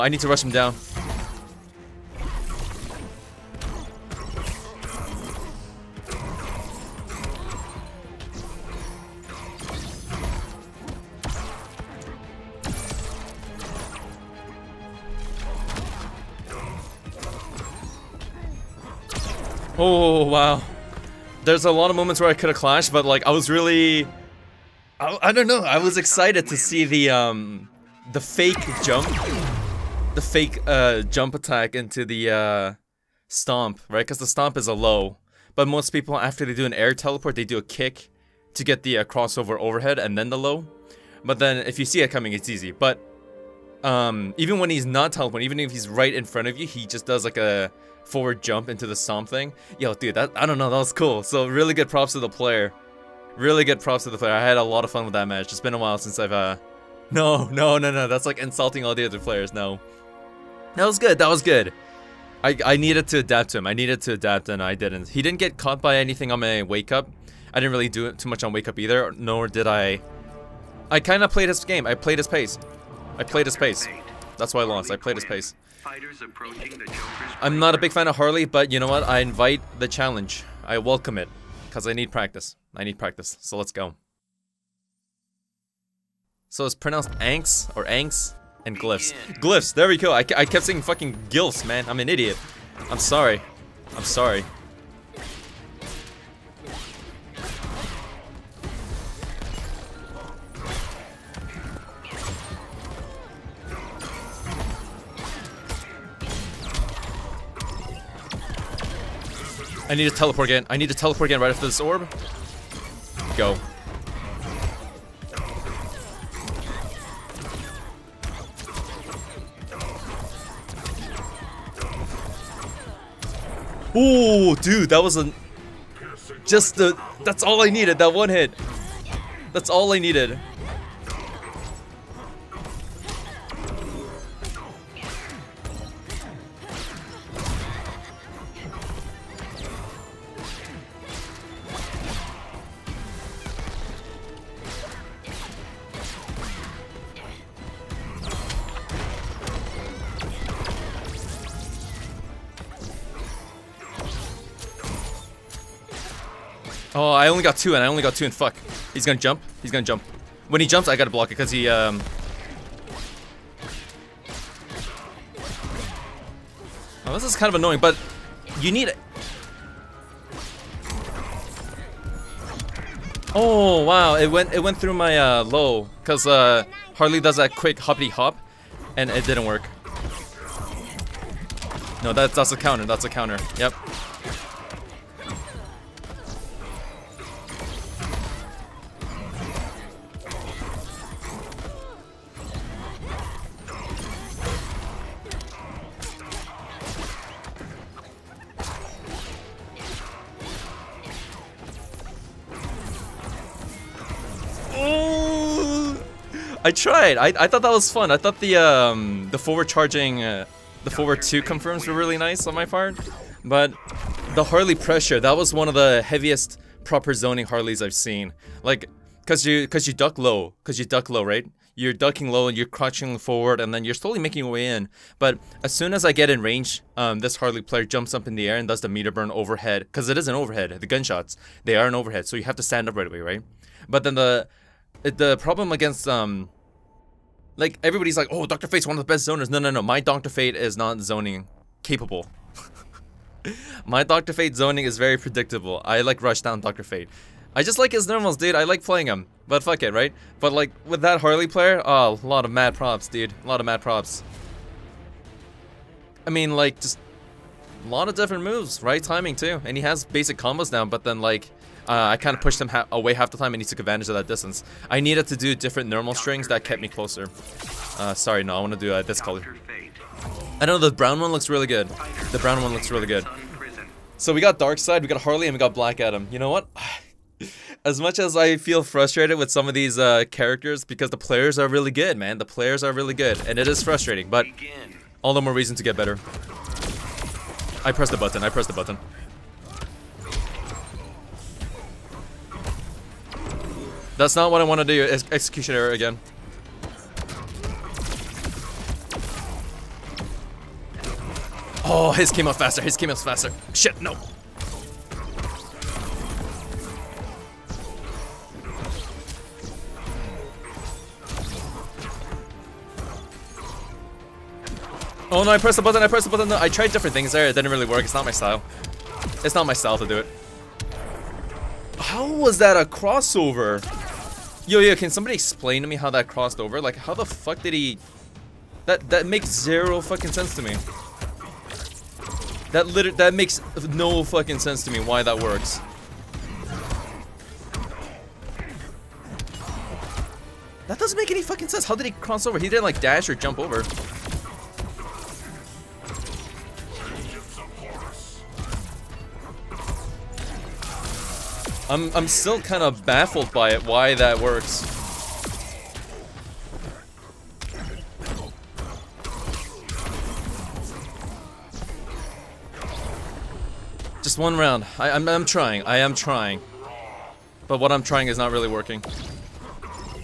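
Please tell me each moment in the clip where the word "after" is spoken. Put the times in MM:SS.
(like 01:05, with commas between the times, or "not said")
00:36, 01:51.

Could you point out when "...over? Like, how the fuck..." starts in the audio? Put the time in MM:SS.
05:26.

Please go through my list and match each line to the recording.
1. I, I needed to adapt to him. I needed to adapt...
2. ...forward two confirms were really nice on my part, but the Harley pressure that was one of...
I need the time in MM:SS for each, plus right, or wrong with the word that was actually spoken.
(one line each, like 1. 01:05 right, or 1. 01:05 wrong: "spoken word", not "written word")
1. 01:02 right
2. 03:30 right.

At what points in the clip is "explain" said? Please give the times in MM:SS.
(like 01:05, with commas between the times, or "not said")
05:25.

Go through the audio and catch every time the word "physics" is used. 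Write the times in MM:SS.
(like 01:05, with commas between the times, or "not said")
not said.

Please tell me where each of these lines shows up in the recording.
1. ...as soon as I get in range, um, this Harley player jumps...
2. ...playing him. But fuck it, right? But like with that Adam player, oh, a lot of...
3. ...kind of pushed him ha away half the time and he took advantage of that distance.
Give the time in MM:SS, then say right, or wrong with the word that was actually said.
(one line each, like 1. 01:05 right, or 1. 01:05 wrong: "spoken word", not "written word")
1. 03:45 right
2. 04:08 wrong: "Harley", not "Adam"
3. 04:22 right.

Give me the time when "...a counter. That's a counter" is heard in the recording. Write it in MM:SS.
03:02.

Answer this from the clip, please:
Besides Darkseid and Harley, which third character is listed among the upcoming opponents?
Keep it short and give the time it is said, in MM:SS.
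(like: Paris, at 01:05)
Black Adam, at 04:35.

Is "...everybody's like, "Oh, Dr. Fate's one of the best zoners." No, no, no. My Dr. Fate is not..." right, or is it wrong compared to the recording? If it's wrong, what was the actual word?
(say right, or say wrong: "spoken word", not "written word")
right.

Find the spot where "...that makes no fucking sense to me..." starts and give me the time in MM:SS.
05:33.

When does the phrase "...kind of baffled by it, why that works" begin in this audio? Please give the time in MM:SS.
05:52.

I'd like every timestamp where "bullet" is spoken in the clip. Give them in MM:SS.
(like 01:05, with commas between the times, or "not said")
not said.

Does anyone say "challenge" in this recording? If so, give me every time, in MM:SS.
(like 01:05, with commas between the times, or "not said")
01:19.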